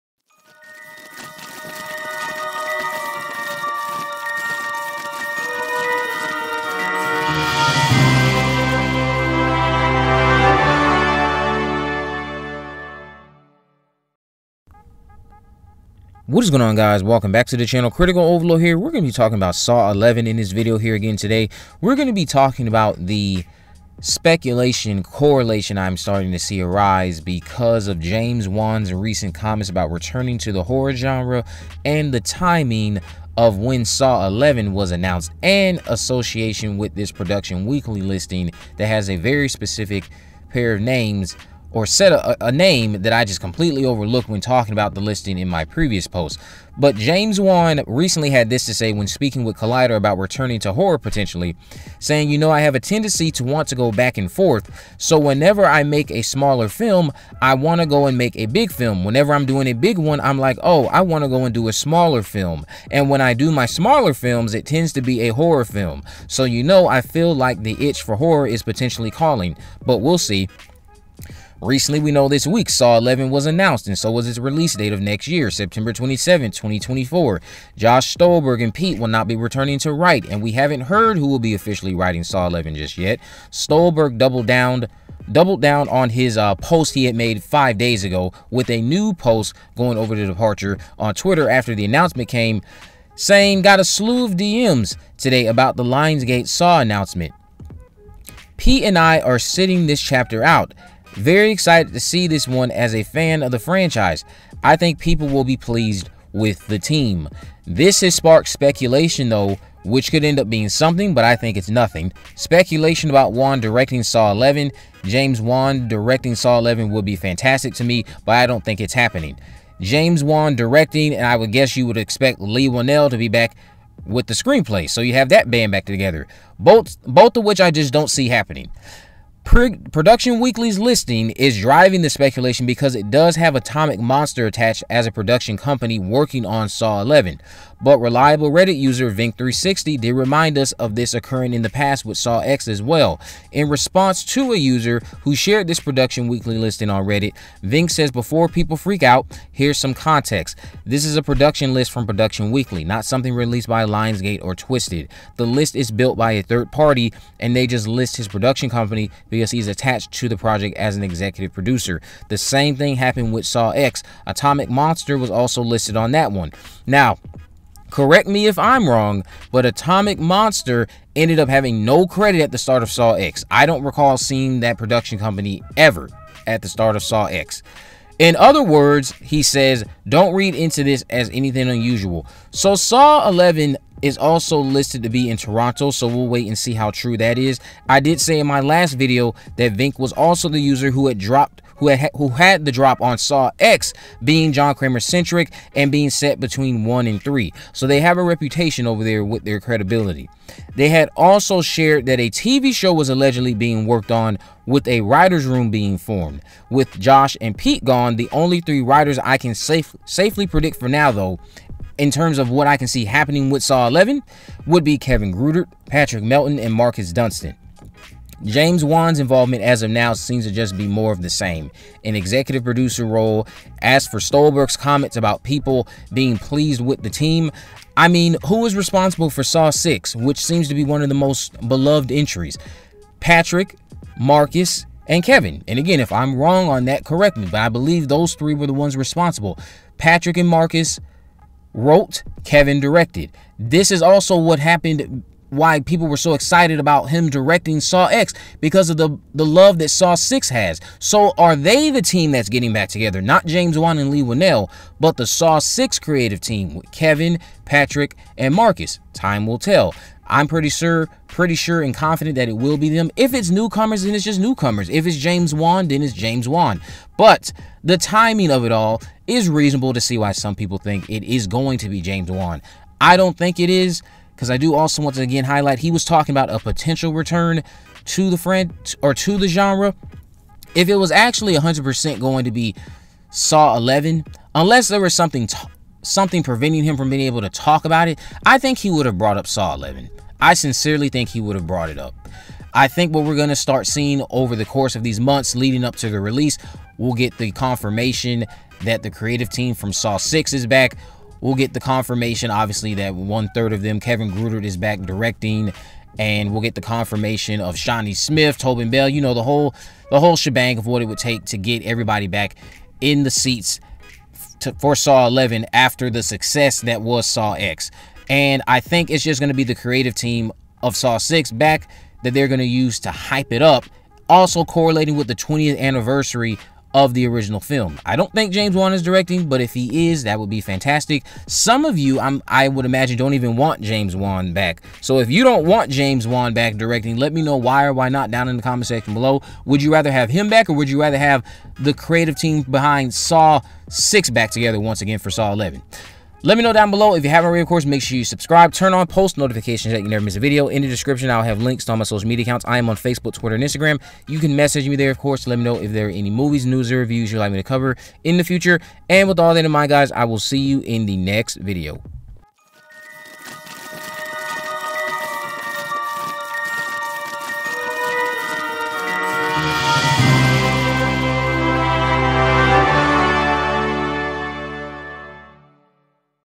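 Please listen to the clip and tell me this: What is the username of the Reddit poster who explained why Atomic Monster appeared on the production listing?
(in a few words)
Vink360.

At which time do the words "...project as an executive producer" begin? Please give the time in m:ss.
2:40.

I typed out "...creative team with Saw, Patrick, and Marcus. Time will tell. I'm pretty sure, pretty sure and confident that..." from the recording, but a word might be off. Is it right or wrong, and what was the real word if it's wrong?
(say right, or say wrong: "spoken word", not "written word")
wrong: "Kevin", not "Saw".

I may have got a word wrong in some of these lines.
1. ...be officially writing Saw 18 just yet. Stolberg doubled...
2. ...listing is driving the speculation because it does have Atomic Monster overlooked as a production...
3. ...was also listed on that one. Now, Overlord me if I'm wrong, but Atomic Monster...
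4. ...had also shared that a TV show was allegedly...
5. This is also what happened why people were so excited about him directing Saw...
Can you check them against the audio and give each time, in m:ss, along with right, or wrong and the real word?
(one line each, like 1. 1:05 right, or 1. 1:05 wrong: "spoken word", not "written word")
1. 1:21 wrong: "11", not "18"
2. 2:10 wrong: "attached", not "overlooked"
3. 2:45 wrong: "Correct", not "Overlord"
4. 3:20 right
5. 4:03 right.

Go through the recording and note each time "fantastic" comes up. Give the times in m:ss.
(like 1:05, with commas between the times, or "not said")
1:57, 5:30.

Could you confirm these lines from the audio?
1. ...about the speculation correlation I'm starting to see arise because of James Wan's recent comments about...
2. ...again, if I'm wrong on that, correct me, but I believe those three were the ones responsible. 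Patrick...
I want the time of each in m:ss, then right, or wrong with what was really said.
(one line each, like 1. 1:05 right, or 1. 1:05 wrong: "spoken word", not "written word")
1. 0:22 right
2. 3:55 right.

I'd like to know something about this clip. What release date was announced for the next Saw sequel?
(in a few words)
September 27, 2024.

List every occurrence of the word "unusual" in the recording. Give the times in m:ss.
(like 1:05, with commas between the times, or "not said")
3:01.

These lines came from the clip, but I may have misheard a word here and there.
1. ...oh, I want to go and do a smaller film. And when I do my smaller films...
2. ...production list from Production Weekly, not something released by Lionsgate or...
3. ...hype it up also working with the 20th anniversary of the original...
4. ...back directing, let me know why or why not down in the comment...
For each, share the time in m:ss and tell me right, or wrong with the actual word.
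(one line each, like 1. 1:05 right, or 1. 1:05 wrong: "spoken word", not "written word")
1. 1:00 right
2. 2:31 right
3. 5:23 wrong: "correlating", not "working"
4. 5:36 right.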